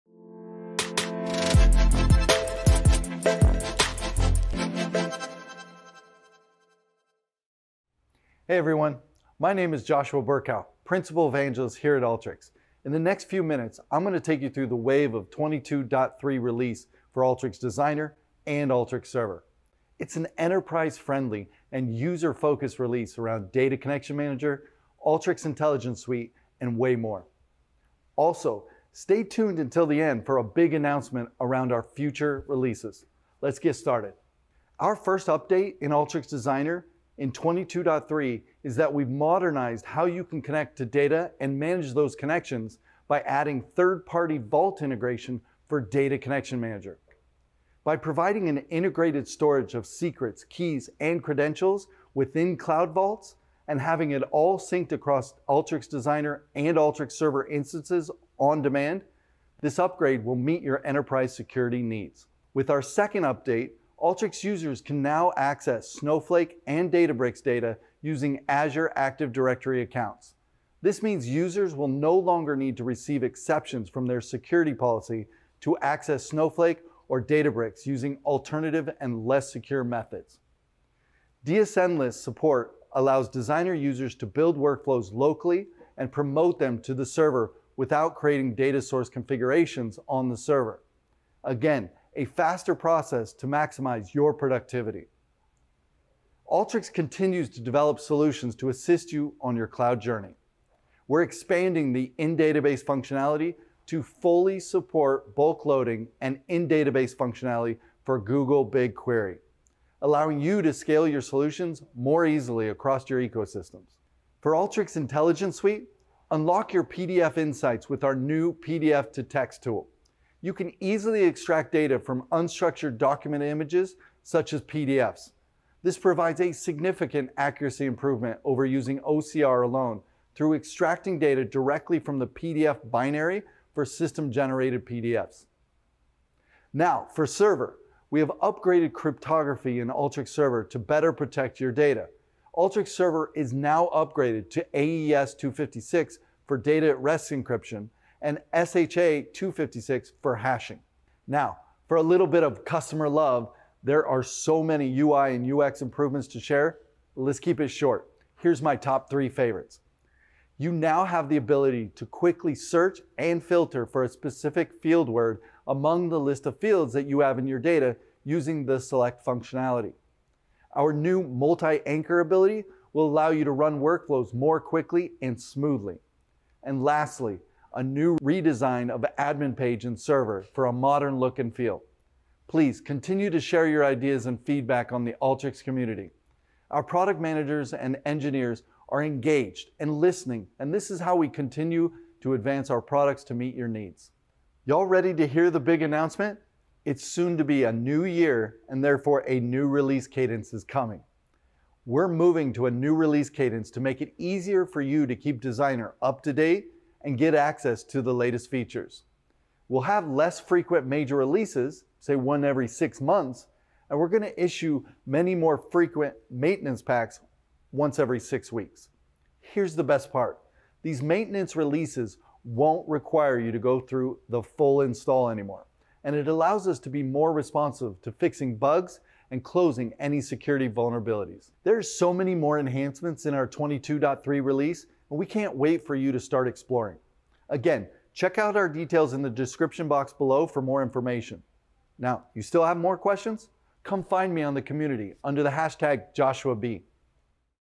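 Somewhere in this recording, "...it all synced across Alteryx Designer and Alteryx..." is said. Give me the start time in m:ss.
0:54.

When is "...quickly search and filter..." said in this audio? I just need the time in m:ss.
2:42.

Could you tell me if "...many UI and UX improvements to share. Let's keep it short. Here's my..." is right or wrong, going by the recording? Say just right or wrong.
right.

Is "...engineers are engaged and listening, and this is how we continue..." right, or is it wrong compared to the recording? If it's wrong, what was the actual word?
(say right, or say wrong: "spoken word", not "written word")
right.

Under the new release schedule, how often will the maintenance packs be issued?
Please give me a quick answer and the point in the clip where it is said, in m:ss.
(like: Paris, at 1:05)
every 6 weeks, at 3:37.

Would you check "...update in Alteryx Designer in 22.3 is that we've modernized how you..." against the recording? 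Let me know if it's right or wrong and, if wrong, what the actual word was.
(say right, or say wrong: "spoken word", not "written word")
right.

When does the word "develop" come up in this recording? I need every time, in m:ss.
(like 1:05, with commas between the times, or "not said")
1:37.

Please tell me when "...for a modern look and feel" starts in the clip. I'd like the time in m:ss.
3:00.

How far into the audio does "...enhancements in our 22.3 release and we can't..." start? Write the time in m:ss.
3:52.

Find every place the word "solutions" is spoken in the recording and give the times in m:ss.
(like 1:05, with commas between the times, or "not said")
1:37, 1:51.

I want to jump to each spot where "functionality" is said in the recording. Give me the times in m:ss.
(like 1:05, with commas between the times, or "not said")
1:42, 1:47, 2:49.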